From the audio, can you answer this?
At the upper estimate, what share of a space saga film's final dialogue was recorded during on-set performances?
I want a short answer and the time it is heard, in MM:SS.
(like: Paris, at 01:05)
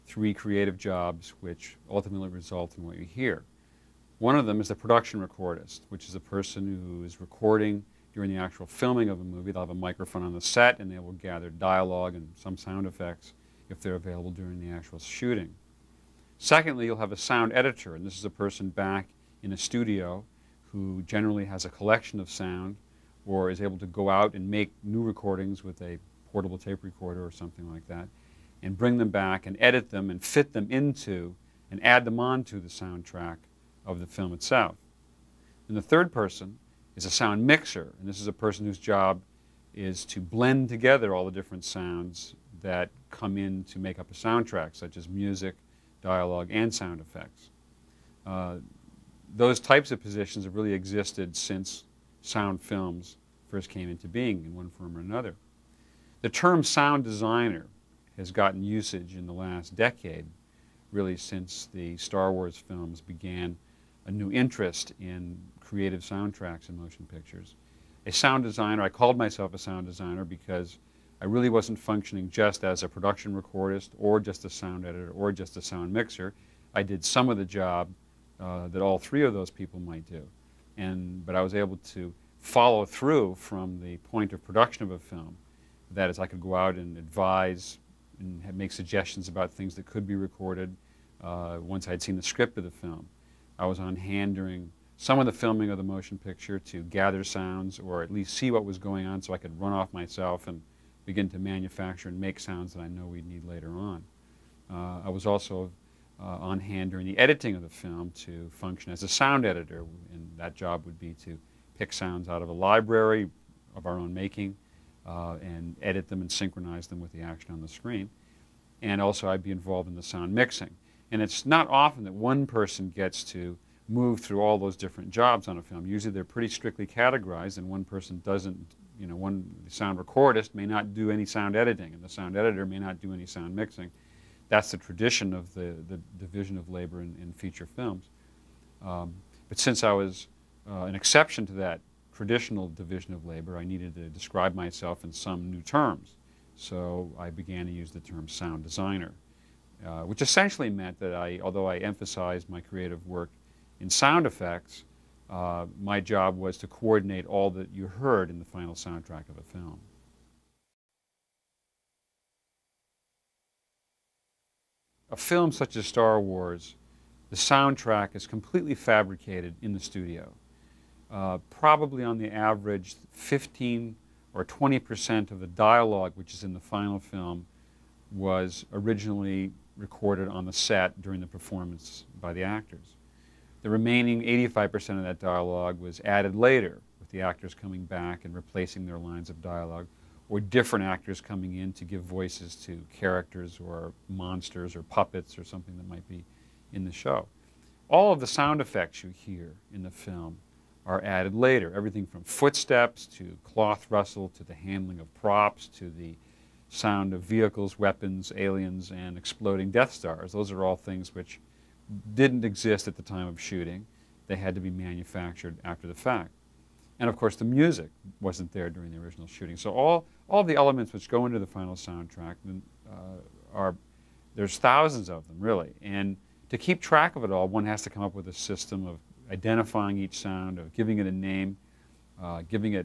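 20 percent, at 02:54.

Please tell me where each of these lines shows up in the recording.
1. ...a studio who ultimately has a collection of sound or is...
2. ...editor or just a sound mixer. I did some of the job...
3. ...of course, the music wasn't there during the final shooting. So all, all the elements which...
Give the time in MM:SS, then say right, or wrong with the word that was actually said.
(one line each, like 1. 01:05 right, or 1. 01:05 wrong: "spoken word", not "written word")
1. 00:19 wrong: "generally", not "ultimately"
2. 01:14 right
3. 03:37 wrong: "original", not "final".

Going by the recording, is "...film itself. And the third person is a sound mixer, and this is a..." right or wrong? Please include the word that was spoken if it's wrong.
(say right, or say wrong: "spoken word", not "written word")
right.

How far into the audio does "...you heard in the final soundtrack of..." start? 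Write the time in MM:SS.
02:37.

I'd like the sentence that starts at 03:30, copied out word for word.
Those are all things which didn't exist at the time of shooting.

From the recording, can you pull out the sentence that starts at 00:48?
Uh, those types of positions have really existed since sound films first came into being in one form or another.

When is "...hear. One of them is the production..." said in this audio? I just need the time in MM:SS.
00:03.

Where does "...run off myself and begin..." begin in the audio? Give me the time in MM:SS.
01:39.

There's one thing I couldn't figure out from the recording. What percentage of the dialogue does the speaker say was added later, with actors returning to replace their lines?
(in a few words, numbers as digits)
85 percent.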